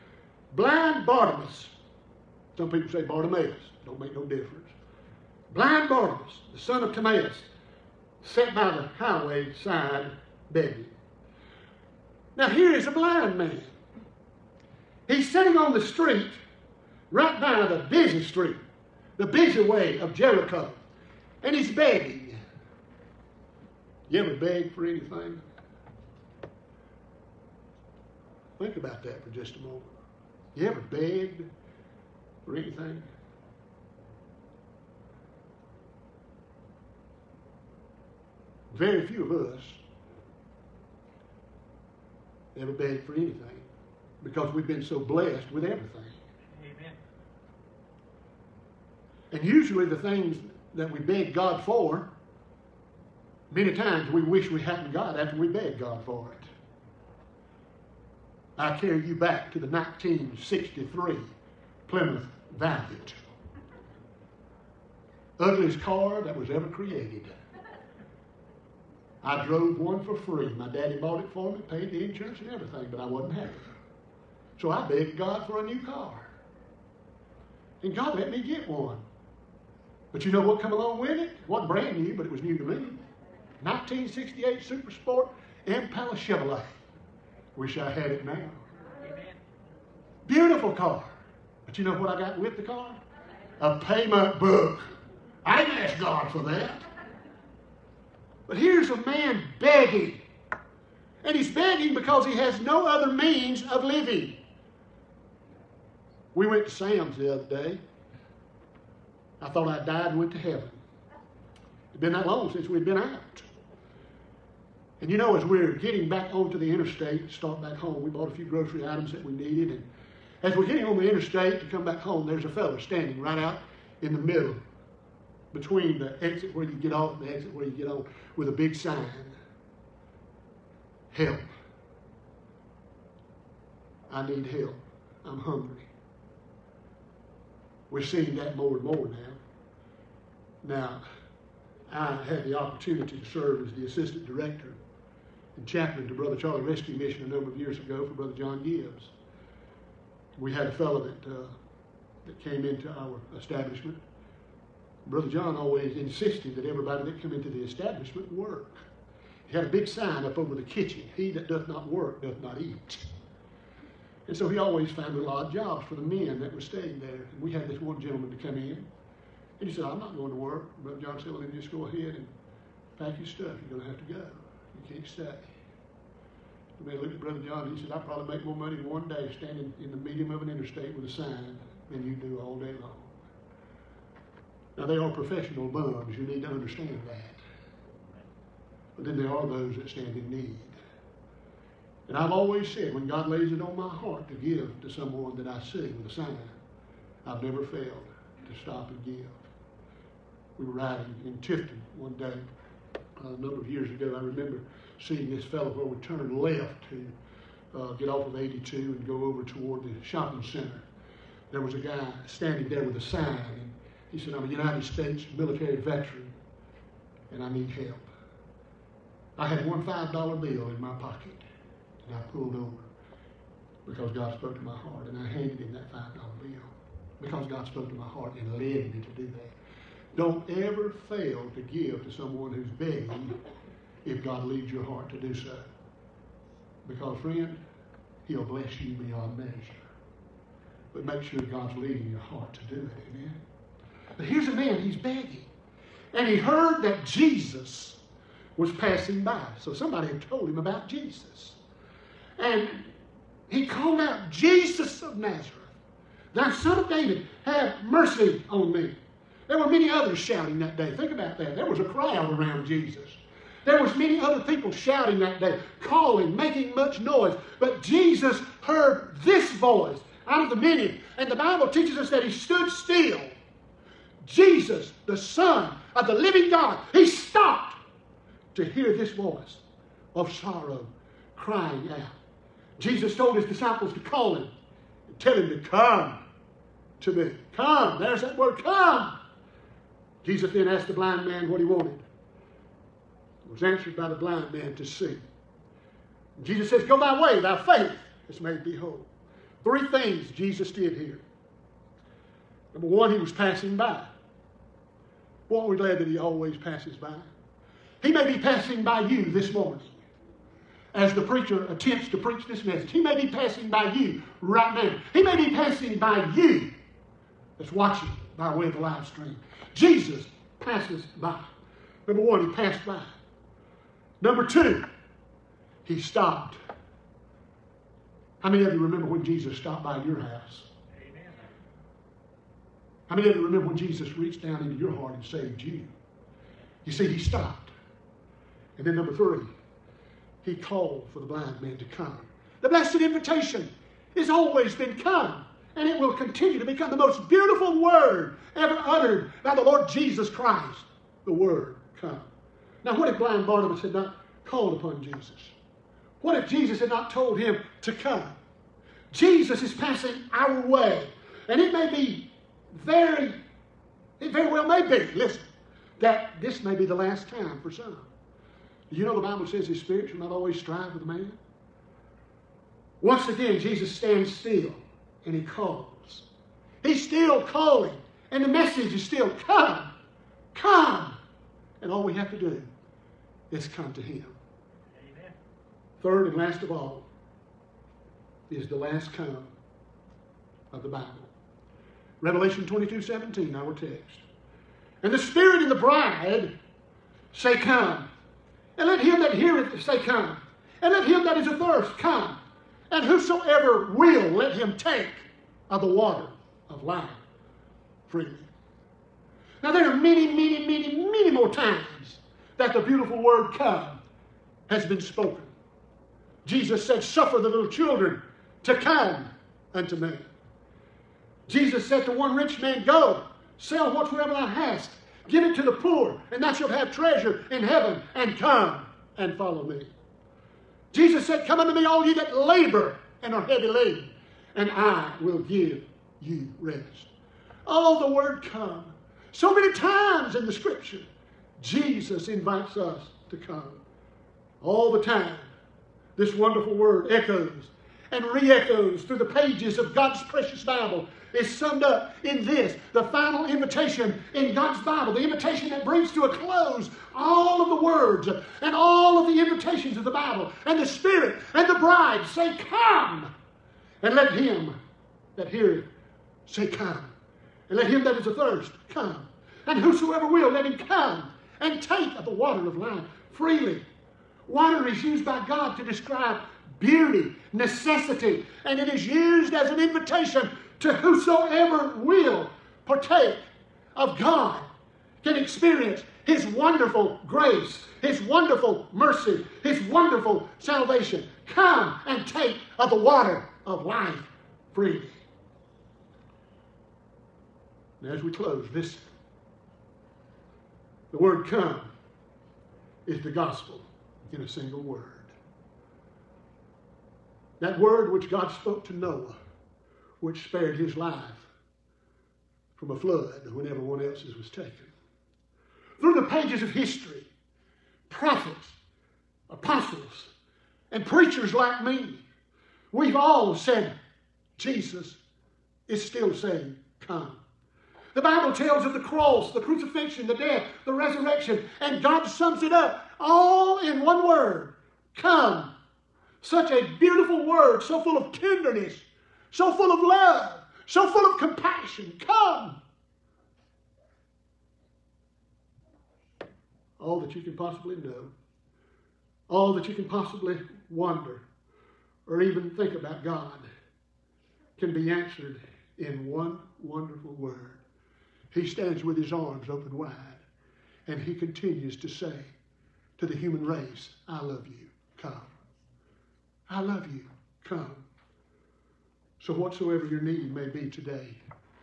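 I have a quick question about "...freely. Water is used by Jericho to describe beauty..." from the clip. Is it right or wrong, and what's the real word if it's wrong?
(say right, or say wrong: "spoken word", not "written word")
wrong: "God", not "Jericho".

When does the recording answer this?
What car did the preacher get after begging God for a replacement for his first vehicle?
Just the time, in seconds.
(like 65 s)
83 s.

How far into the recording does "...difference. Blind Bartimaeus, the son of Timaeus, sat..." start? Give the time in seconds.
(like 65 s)
4 s.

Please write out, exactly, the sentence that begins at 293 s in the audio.
It was answered by the blind man to see.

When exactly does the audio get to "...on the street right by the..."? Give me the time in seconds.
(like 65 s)
15 s.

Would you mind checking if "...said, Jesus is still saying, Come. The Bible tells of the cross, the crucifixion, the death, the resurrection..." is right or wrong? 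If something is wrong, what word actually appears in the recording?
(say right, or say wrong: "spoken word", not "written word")
right.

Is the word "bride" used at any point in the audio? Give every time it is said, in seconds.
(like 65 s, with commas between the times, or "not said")
395 s, 461 s.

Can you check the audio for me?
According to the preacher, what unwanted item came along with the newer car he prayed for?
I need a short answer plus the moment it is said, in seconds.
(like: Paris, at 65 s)
A payment book, at 93 s.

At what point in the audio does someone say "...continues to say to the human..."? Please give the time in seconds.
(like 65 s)
561 s.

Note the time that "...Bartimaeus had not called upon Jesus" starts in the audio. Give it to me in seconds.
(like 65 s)
353 s.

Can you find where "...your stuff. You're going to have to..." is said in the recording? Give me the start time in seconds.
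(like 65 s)
173 s.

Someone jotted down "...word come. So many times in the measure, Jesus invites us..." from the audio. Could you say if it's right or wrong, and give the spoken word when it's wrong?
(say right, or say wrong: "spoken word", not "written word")
wrong: "scripture", not "measure".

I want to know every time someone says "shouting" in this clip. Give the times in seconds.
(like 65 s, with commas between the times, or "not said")
260 s, 264 s.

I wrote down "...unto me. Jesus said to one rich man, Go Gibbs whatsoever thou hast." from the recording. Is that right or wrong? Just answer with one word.
wrong.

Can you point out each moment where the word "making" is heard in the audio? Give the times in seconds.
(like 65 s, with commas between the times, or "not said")
266 s.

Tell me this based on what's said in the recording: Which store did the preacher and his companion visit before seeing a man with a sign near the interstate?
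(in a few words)
Sam's.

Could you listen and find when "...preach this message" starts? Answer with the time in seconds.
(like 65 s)
312 s.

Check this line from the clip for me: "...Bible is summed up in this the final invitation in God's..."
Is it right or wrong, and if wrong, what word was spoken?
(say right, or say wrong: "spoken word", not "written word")
right.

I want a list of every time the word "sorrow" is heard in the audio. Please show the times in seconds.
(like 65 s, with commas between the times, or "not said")
280 s.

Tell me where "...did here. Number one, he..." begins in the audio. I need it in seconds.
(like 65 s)
300 s.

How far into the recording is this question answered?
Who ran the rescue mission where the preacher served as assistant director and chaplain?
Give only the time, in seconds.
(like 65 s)
148 s.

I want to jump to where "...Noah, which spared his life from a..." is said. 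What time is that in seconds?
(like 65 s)
508 s.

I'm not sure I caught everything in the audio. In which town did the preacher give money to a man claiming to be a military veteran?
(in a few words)
Tifton.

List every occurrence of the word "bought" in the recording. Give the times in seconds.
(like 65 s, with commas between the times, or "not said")
70 s, 118 s.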